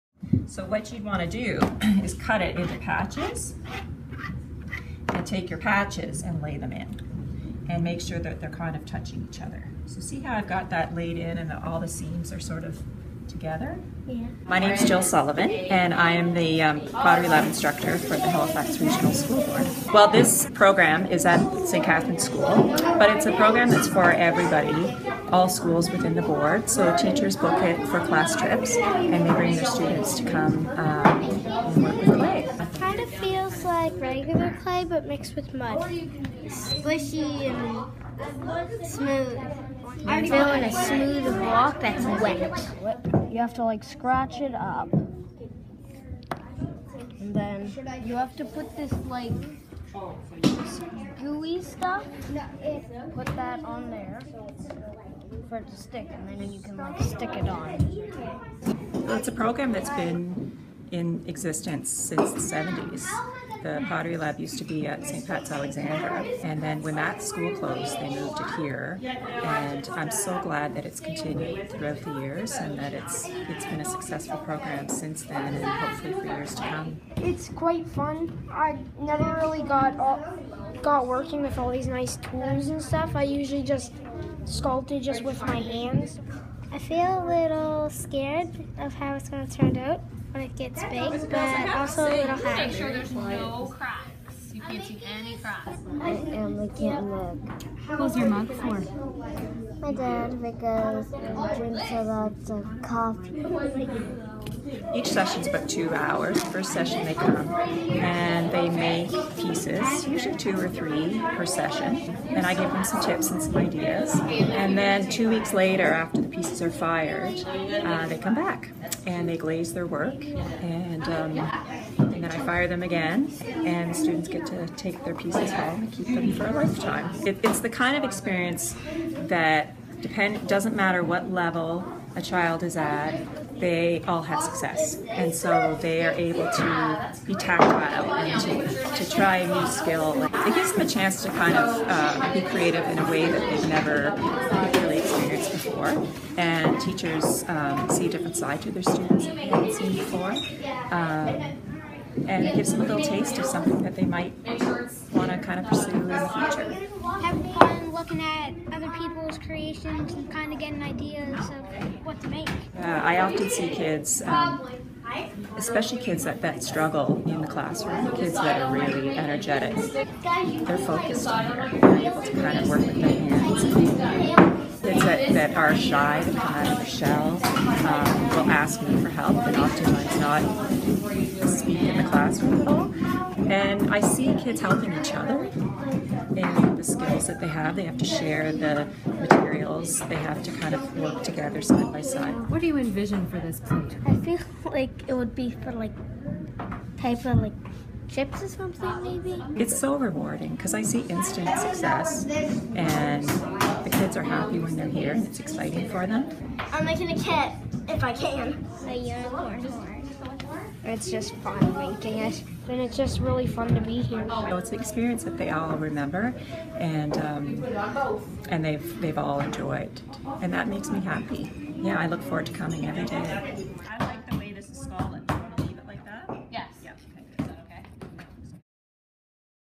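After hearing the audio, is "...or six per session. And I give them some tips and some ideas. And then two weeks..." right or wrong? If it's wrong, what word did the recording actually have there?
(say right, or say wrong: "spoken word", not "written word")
wrong: "three", not "six".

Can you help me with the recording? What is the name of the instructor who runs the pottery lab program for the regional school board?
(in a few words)
Jill Sullivan.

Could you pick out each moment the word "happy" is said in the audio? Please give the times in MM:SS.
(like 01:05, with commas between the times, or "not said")
03:24, 03:40.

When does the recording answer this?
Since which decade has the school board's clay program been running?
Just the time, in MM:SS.
01:02.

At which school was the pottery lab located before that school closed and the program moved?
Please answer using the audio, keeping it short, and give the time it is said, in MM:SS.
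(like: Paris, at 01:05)
St. Pat's Alexandra, at 01:05.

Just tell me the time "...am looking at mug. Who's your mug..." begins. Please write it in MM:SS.
01:36.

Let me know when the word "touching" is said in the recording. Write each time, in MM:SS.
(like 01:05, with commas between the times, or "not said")
00:08.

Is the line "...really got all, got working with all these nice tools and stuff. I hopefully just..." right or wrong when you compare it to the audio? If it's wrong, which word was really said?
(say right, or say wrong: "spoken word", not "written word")
wrong: "usually", not "hopefully".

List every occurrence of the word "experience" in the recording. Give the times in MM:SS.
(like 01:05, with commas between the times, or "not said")
02:08, 03:34.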